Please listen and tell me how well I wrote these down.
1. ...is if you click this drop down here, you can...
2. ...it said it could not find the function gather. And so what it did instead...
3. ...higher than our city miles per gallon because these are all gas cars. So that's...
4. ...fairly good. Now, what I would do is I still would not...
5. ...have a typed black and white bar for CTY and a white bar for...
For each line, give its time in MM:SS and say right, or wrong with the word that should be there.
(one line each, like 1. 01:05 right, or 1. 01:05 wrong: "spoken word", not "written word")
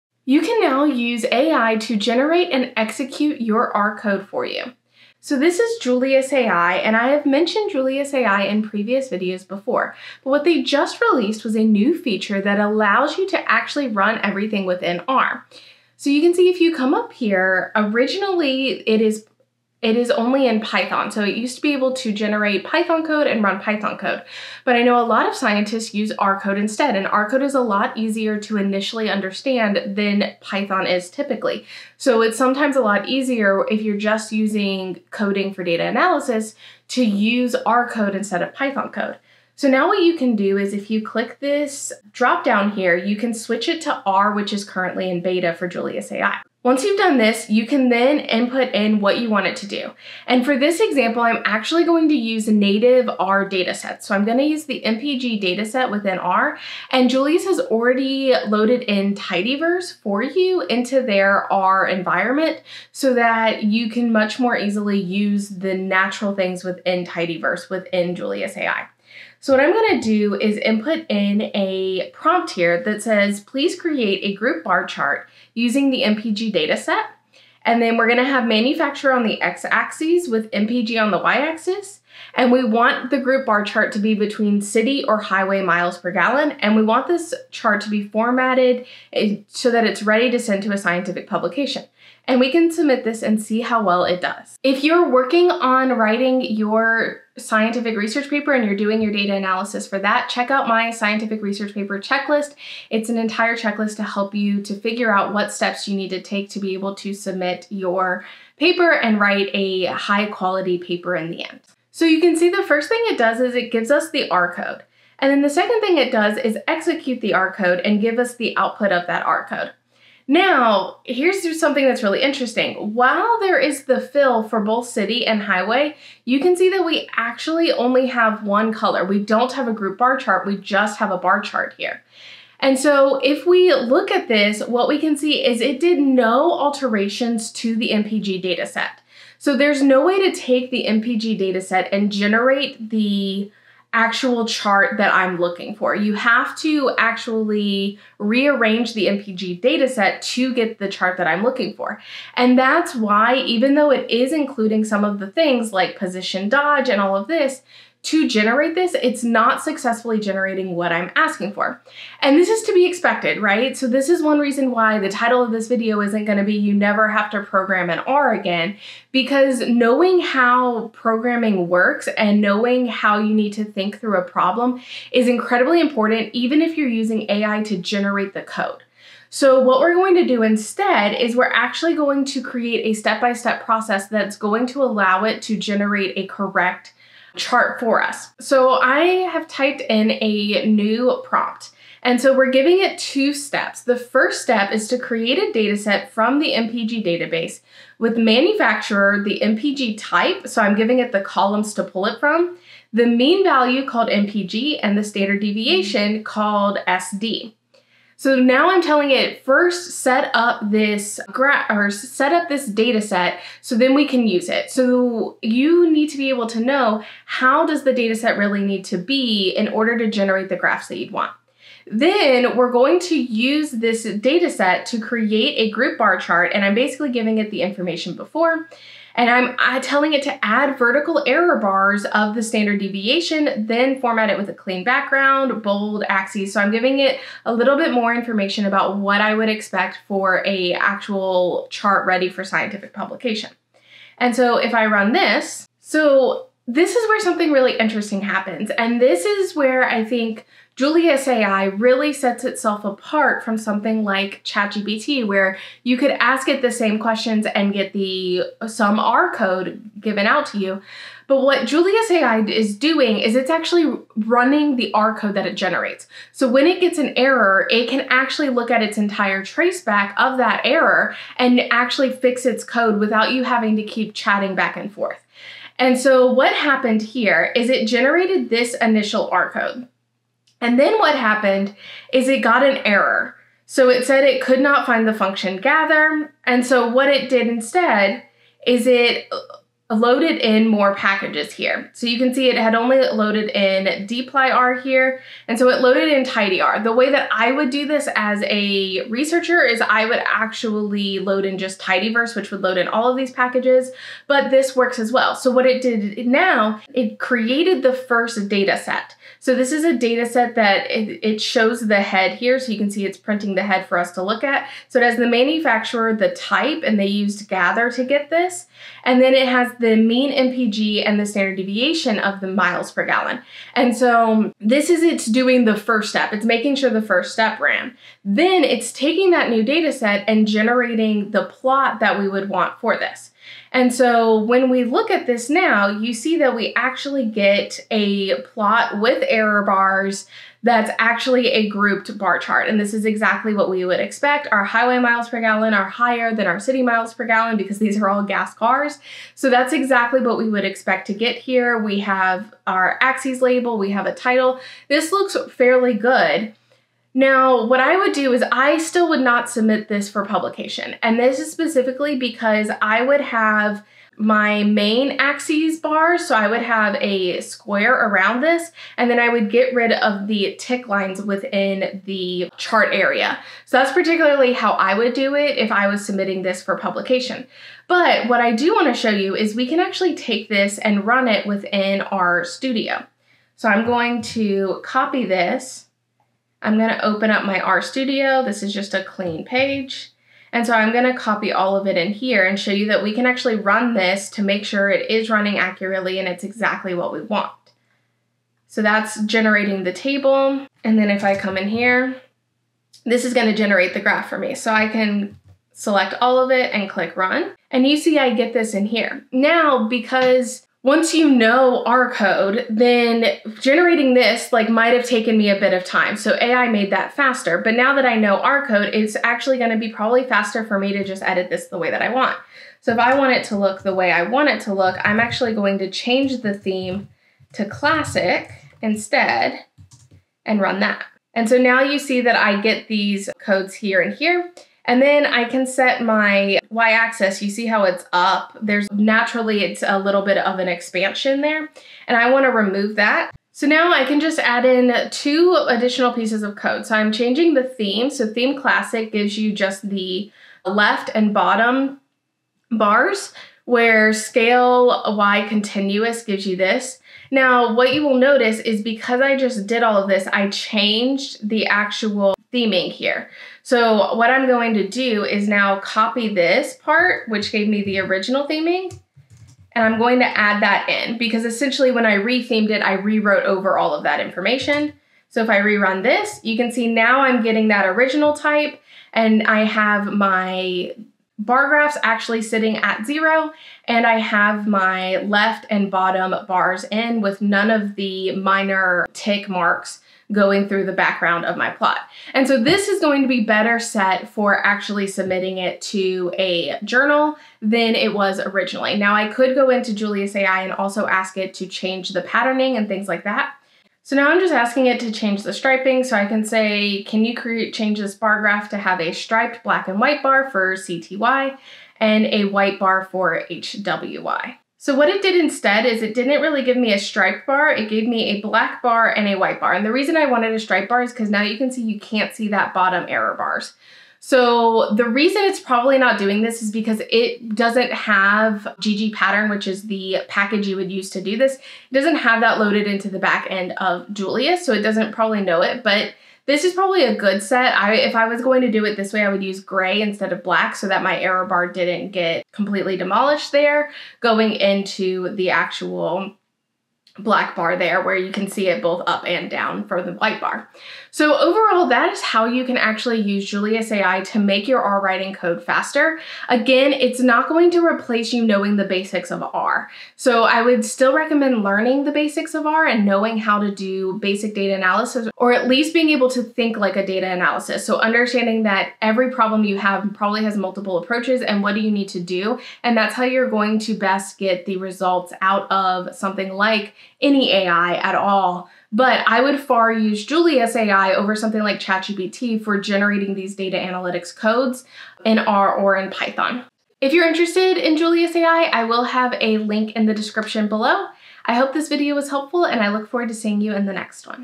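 1. 00:40 right
2. 04:43 right
3. 05:45 right
4. 05:55 right
5. 08:28 wrong: "striped", not "typed".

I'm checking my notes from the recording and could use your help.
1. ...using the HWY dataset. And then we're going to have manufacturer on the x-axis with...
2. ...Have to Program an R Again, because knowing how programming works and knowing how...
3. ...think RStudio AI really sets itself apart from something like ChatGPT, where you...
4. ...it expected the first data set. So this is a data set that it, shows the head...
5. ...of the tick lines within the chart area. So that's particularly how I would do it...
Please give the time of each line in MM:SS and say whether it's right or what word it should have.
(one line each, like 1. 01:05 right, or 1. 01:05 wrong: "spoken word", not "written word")
1. 01:15 wrong: "MPG", not "HWY"
2. 02:47 right
3. 04:10 wrong: "Julius", not "RStudio"
4. 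05:06 wrong: "created", not "expected"
5. 06:09 right.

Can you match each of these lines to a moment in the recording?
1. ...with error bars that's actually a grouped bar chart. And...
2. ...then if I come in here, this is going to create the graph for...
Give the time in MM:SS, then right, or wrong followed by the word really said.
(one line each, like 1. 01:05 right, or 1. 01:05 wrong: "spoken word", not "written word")
1. 05:39 right
2. 06:40 wrong: "generate", not "create".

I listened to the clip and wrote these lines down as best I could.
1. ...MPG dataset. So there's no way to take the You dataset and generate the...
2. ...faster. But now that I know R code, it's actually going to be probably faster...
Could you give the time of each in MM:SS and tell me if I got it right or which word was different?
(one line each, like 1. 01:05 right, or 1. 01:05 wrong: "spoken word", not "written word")
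1. 02:17 wrong: "MPG", not "You"
2. 06:57 right.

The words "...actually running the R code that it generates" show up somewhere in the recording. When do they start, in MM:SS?
04:23.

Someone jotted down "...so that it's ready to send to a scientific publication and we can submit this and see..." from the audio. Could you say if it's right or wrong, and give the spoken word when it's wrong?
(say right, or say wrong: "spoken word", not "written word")
right.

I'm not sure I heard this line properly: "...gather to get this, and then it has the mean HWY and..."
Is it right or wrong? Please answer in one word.
wrong.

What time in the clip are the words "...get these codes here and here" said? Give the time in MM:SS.
07:12.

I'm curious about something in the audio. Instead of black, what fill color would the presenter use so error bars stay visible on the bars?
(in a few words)
gray.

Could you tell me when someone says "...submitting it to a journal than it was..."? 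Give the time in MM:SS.
08:15.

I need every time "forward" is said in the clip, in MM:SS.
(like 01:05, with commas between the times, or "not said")
09:53.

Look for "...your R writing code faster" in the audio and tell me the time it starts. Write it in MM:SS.
09:14.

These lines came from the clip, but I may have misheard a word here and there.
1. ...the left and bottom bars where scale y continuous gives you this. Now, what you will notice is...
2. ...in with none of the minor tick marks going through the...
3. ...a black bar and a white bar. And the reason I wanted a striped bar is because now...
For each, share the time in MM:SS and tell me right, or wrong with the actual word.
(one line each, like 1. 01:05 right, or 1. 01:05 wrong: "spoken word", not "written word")
1. 07:29 right
2. 08:06 right
3. 08:38 right.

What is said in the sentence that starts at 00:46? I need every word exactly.
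Once you've done this, you can then input in what you want it to do.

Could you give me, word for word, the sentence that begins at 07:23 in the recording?
So now I can just add in two additional pieces of code.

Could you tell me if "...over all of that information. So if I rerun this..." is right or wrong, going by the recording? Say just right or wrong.
right.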